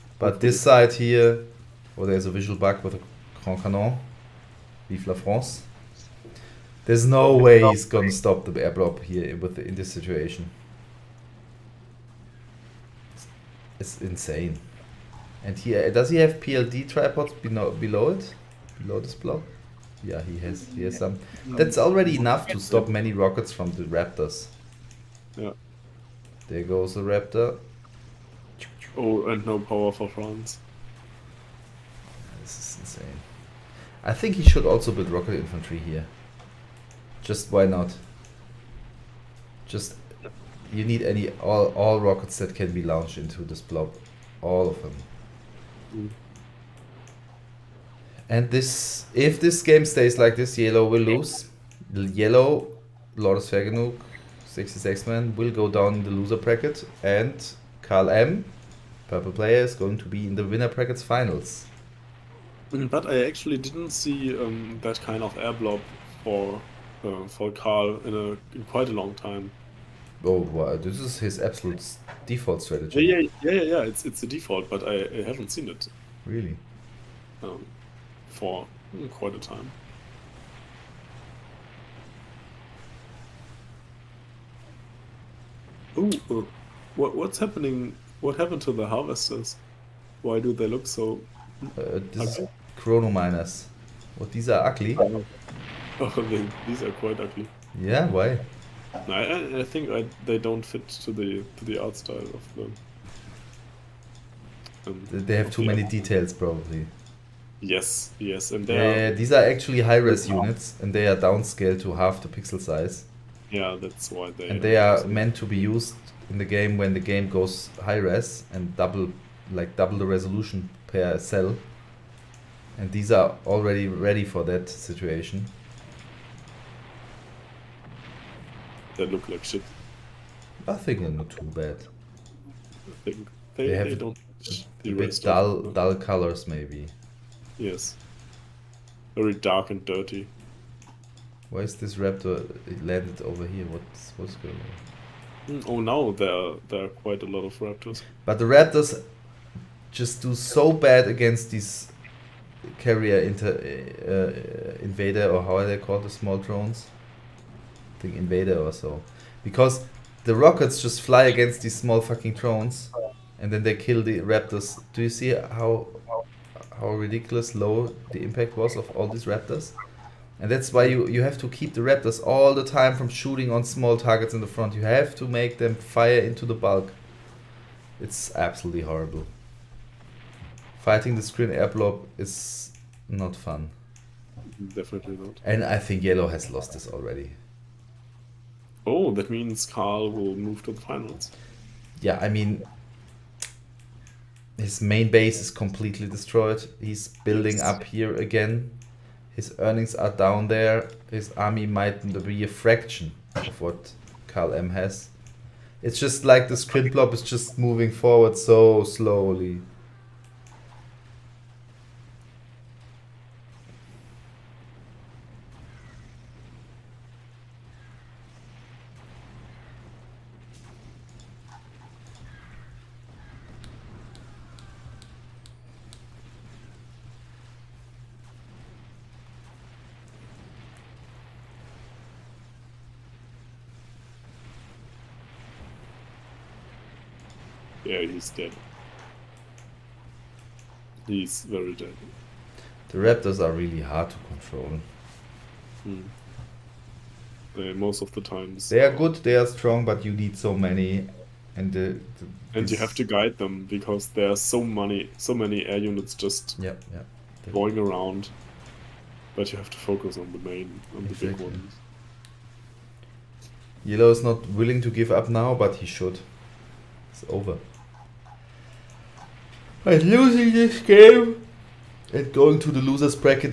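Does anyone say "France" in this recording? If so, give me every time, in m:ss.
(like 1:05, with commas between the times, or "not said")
0:05, 0:30.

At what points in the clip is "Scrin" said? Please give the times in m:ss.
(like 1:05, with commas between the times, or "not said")
3:01, 3:26.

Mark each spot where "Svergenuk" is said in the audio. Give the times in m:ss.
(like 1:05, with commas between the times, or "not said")
0:53.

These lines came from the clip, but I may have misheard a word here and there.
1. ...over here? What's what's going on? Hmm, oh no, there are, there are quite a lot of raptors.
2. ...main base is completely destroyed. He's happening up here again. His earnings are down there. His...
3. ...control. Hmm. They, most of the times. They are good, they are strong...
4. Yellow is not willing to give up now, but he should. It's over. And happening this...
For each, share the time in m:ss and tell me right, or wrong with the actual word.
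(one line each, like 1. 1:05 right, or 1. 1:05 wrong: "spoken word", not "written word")
1. 2:23 right
2. 3:14 wrong: "building", not "happening"
3. 4:04 right
4. 4:23 wrong: "losing", not "happening".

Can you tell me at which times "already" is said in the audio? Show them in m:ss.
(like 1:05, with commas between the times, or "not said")
0:21, 2:03, 3:06.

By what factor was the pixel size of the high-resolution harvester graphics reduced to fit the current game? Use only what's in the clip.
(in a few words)
half.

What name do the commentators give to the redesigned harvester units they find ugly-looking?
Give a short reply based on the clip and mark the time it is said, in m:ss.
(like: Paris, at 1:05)
chronominers, at 1:32.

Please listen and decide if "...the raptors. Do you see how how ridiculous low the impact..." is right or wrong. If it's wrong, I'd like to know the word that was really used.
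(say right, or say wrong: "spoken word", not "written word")
right.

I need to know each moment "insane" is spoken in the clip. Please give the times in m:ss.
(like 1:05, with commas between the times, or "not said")
0:14, 0:32.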